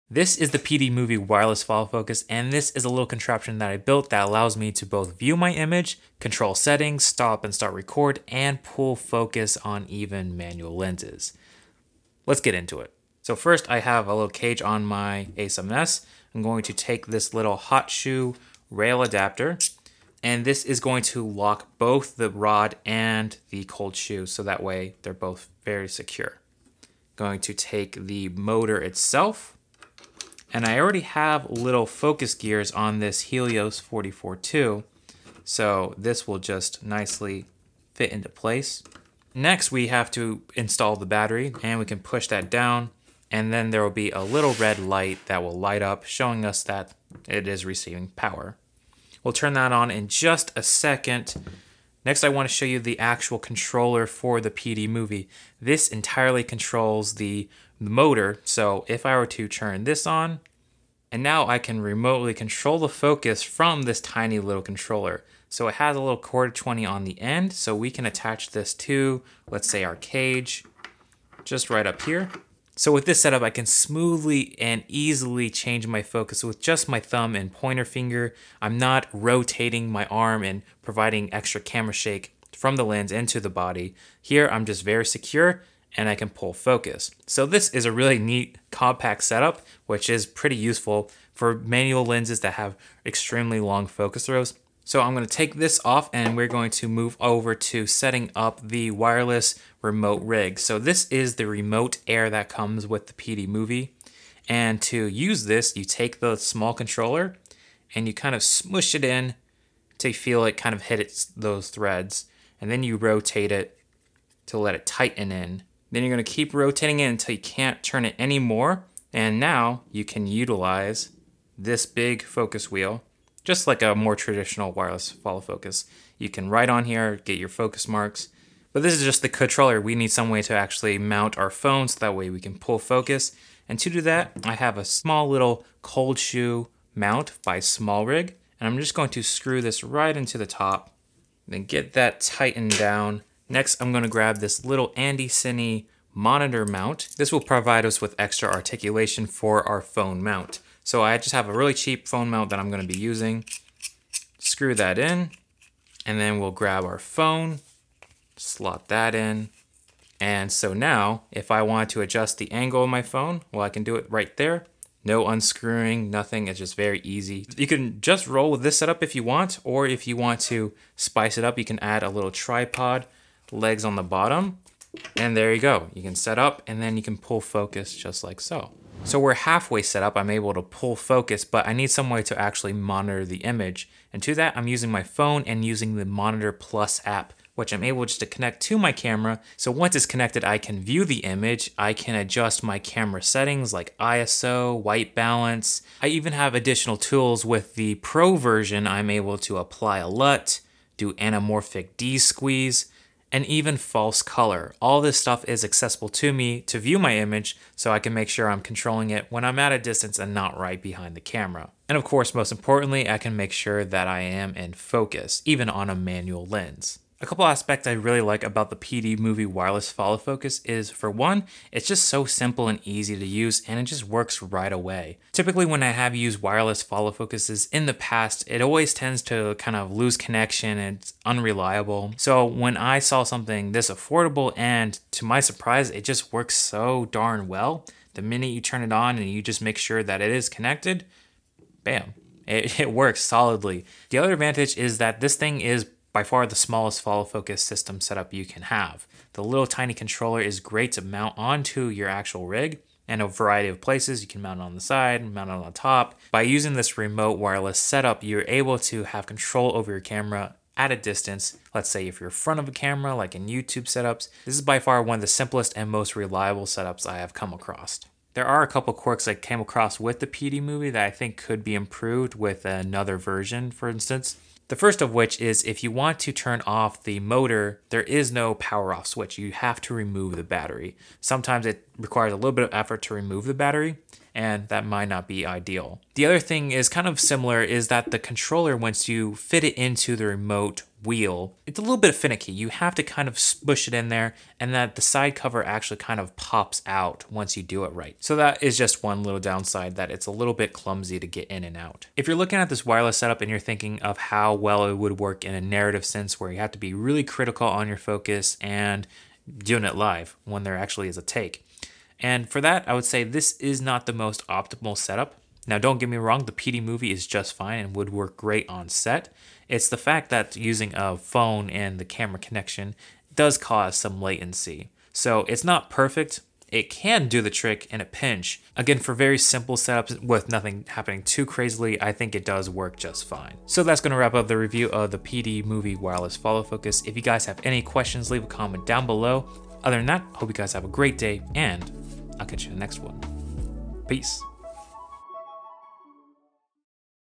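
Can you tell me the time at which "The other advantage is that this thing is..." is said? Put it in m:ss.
4:04.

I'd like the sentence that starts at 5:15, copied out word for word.
Now, don't get me wrong, the PD movie is just fine and would work great on set.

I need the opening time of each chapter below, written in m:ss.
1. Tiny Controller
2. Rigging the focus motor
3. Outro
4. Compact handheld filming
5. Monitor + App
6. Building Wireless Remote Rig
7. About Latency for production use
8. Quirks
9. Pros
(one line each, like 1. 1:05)
1. 0:54
2. 0:15
3. 5:33
4. 1:11
5. 3:00
6. 1:35
7. 5:00
8. 4:29
9. 3:38.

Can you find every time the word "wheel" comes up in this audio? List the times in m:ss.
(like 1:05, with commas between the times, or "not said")
2:02, 4:51.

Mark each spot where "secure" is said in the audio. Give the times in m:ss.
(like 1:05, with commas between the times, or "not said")
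0:25, 1:25.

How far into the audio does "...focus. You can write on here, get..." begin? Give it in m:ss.
2:05.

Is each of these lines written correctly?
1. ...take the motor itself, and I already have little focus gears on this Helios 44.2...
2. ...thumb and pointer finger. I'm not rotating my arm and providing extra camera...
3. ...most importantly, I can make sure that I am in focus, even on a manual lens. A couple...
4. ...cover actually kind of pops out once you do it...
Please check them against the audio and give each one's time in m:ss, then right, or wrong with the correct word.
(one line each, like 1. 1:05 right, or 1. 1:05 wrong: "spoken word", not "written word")
1. 0:27 right
2. 1:16 right
3. 3:32 right
4. 4:55 right.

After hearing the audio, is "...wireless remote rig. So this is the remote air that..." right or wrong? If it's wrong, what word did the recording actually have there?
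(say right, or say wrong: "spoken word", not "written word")
right.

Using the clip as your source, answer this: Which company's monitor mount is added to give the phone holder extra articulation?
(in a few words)
Andycine.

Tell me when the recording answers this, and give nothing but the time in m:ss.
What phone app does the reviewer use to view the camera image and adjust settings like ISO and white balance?
3:06.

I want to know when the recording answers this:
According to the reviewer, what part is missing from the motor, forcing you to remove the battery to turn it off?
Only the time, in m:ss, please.
4:38.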